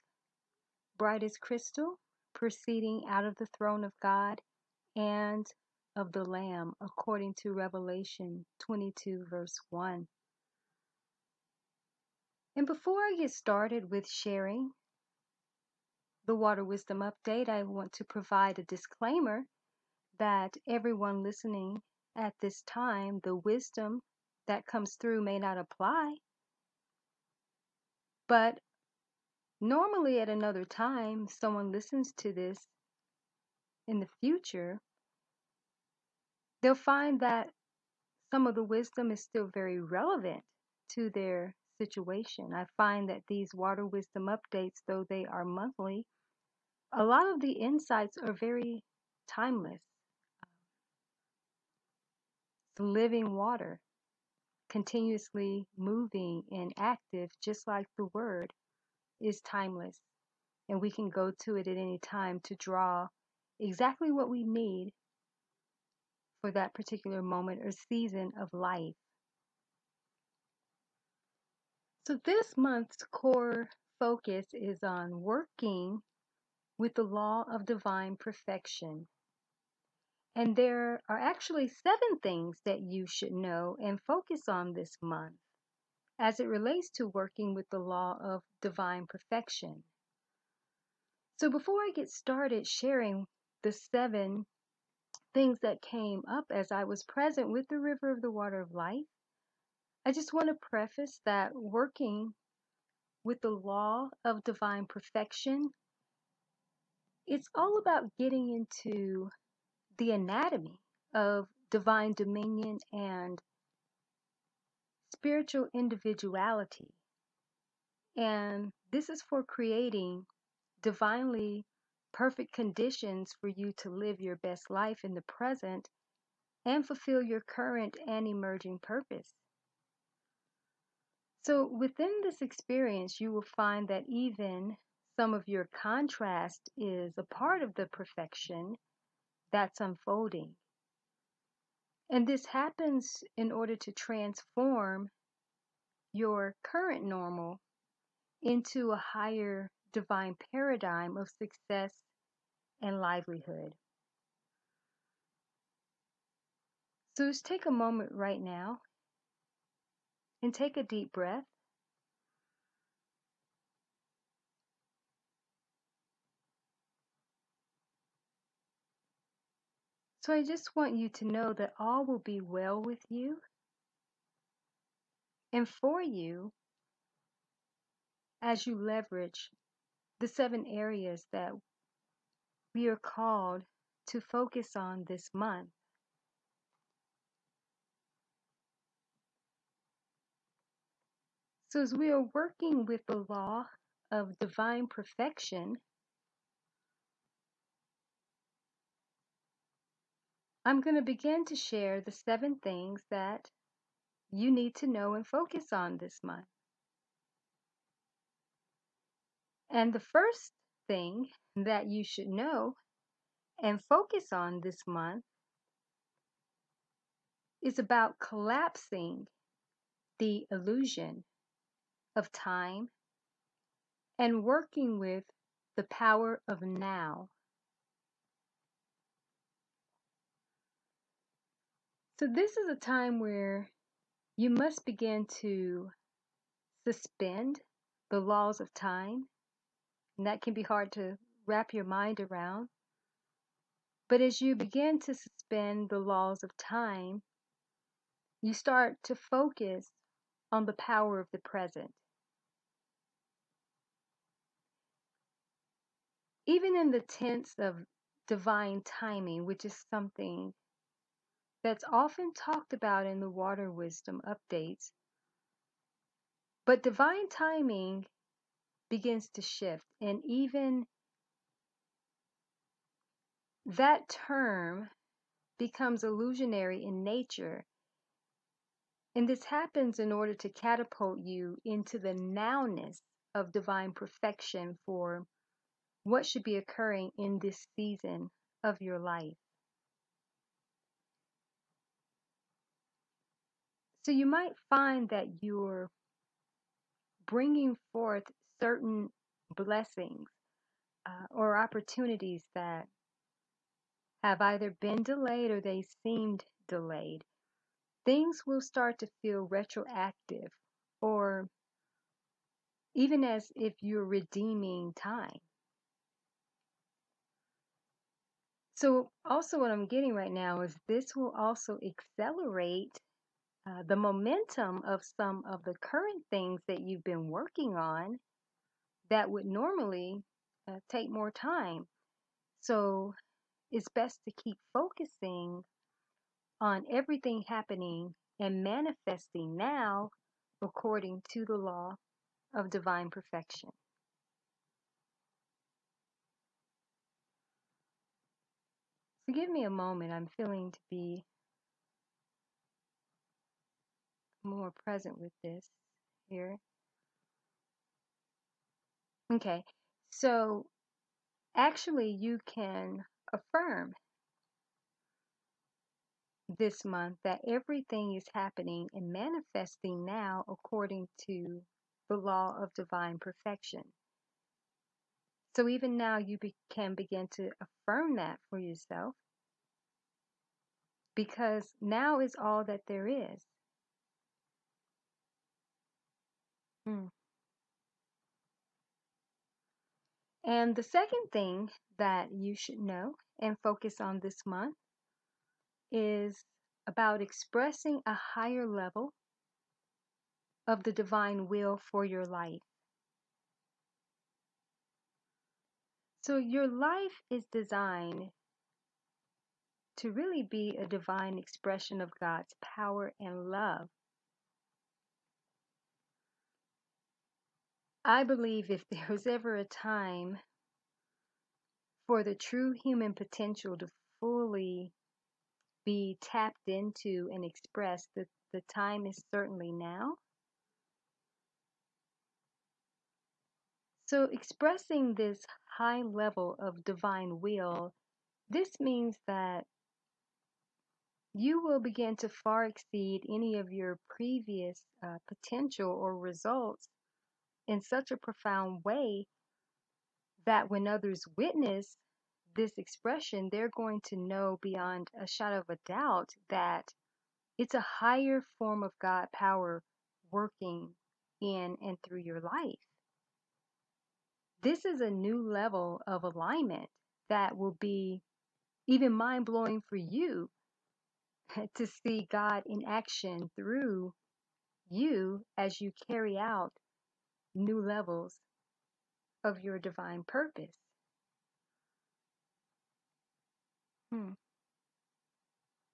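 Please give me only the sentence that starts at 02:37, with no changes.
So just take a moment right now and take a deep breath.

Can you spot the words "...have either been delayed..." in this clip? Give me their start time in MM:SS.
05:04.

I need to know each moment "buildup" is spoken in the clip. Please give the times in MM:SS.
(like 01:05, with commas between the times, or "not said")
not said.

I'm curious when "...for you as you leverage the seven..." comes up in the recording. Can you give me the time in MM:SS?
02:55.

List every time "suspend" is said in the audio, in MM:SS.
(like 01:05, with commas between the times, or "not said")
03:56, 04:05.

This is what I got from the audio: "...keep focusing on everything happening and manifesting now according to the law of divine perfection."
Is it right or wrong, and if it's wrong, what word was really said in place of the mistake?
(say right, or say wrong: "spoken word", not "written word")
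right.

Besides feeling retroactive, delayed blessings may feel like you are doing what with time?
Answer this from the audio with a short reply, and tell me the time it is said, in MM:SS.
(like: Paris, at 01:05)
Redeeming time, at 05:14.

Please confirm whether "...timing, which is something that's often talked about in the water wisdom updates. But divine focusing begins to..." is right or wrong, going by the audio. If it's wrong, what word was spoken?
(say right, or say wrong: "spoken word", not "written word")
wrong: "timing", not "focusing".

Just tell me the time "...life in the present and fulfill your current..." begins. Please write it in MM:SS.
02:04.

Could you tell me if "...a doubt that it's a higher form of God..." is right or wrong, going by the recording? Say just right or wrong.
right.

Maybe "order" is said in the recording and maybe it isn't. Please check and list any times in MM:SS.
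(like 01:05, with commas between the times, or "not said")
02:23, 04:40.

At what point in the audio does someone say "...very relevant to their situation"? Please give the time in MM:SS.
00:39.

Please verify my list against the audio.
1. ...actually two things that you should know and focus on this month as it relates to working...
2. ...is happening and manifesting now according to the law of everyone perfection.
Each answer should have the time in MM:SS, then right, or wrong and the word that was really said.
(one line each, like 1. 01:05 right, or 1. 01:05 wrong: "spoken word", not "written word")
1. 01:21 wrong: "seven", not "two"
2. 06:08 wrong: "divine", not "everyone".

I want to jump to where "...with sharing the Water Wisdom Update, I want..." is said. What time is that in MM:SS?
00:13.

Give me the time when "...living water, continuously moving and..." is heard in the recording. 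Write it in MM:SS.
00:52.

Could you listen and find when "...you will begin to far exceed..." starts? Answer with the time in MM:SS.
07:21.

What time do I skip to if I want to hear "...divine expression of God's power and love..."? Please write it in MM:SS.
06:50.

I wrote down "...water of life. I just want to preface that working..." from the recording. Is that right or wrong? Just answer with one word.
right.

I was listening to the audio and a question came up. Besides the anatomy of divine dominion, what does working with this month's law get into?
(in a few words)
Spiritual individuality.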